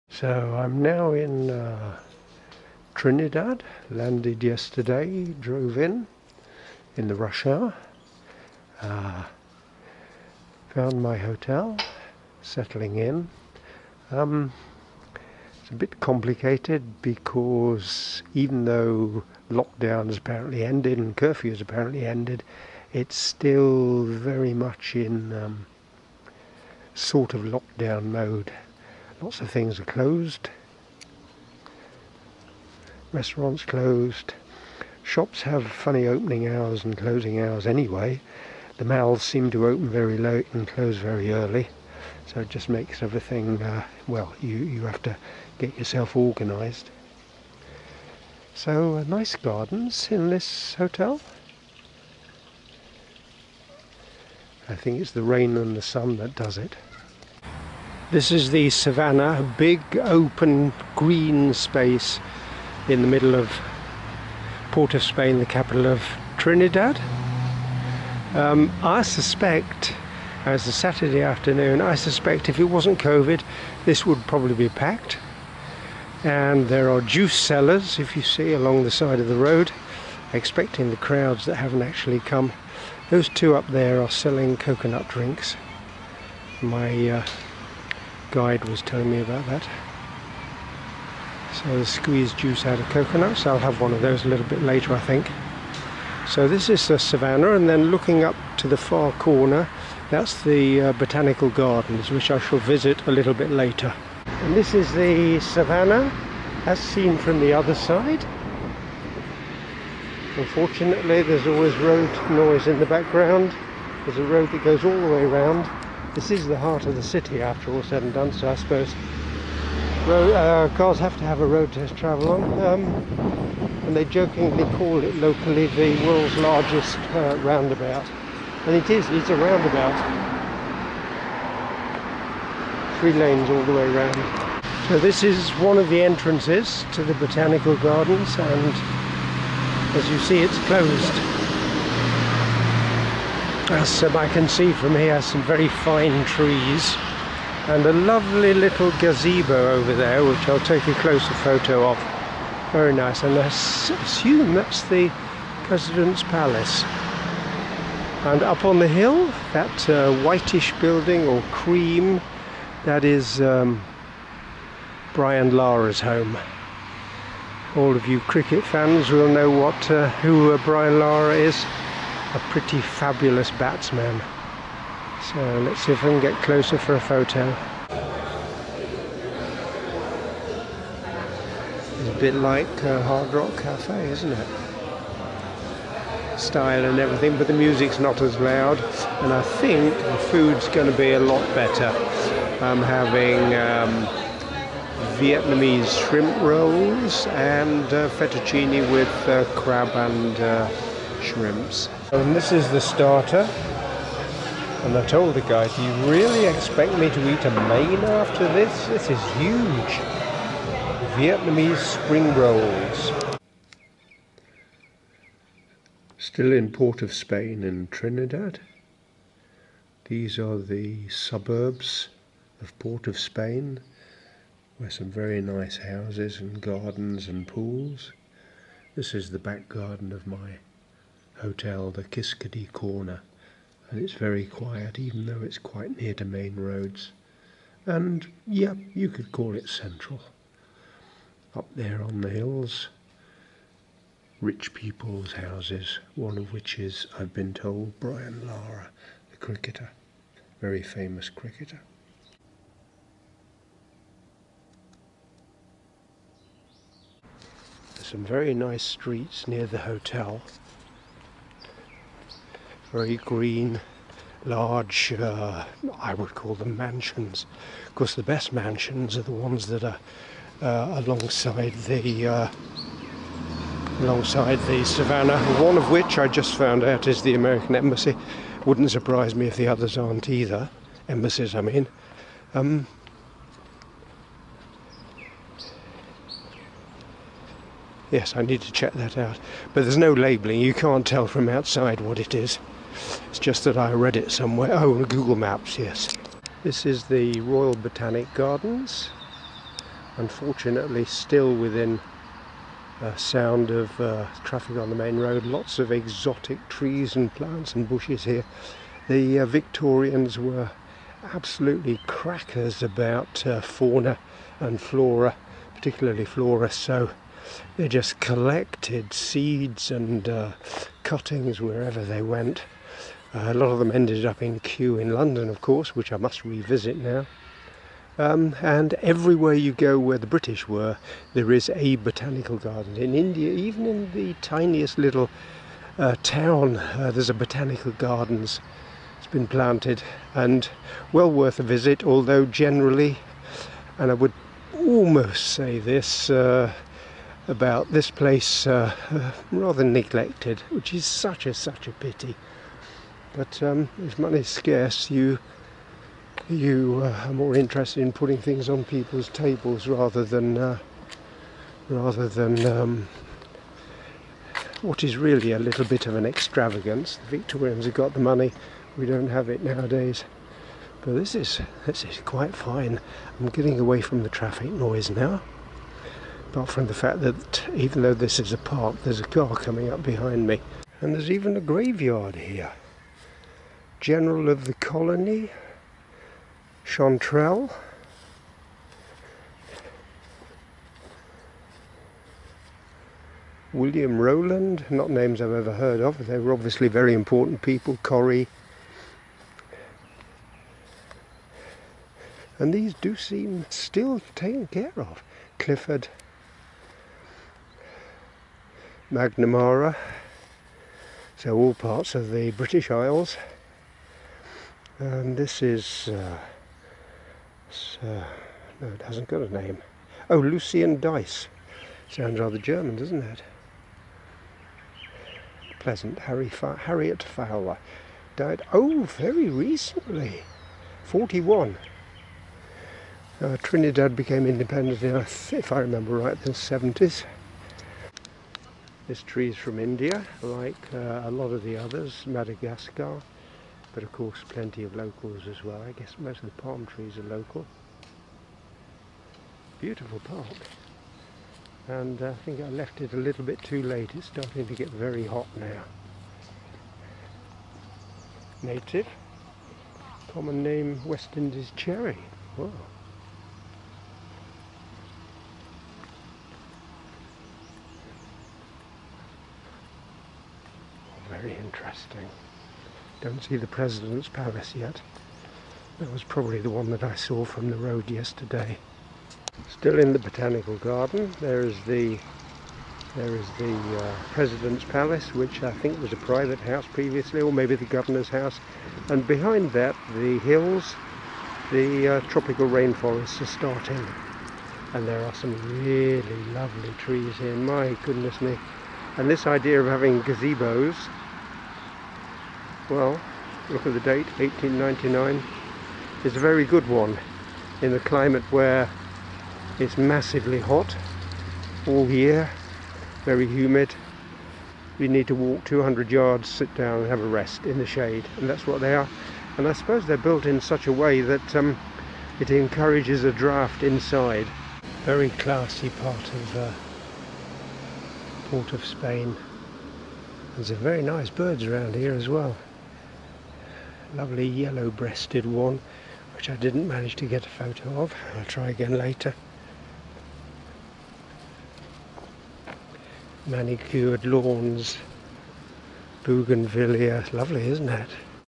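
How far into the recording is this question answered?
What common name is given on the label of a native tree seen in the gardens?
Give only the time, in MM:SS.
07:41.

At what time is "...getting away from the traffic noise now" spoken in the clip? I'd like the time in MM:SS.
06:13.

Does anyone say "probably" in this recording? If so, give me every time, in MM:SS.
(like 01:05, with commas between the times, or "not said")
01:14, 07:56.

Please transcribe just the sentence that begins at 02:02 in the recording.
Um, and they jokingly call it locally the world's largest uh, roundabout.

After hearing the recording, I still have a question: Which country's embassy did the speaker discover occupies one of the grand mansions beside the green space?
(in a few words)
American.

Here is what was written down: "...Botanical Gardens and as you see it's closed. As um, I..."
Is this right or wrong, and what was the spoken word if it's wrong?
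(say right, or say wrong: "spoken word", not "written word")
right.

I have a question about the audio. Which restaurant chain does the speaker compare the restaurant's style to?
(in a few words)
Hard Rock Cafe.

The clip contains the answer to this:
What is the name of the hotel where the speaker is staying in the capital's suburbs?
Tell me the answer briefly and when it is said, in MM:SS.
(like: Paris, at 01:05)
Kiskadee Corner, at 03:51.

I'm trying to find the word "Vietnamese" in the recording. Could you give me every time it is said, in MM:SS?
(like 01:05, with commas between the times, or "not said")
03:15, 03:31.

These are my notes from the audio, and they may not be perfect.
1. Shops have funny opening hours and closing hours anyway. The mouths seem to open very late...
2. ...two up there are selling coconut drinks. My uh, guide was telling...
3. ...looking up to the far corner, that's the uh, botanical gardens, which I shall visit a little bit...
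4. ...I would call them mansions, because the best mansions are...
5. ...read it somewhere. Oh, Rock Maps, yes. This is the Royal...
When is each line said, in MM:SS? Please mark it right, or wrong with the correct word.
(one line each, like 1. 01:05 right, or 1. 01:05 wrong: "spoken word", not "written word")
1. 00:35 right
2. 01:23 right
3. 01:37 right
4. 04:25 right
5. 04:53 wrong: "Google", not "Rock".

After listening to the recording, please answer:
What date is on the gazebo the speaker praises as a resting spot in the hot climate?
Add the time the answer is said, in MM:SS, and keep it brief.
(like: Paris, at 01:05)
1899, at 08:24.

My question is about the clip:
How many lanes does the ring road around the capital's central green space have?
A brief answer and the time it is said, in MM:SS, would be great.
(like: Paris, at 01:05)
3, at 02:12.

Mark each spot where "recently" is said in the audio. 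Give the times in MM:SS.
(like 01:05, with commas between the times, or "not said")
07:09.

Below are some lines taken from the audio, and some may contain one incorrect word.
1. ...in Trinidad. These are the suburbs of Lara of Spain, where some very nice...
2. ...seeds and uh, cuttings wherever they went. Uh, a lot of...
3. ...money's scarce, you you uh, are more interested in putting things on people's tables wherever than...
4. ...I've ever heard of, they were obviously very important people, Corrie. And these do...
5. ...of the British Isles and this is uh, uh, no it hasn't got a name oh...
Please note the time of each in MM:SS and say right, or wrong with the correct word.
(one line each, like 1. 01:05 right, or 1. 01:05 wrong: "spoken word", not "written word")
1. 03:37 wrong: "Port", not "Lara"
2. 05:19 right
3. 05:54 wrong: "rather", not "wherever"
4. 06:35 right
5. 06:52 right.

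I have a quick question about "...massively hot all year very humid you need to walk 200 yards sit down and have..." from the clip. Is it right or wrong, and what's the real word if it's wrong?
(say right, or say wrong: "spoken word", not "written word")
right.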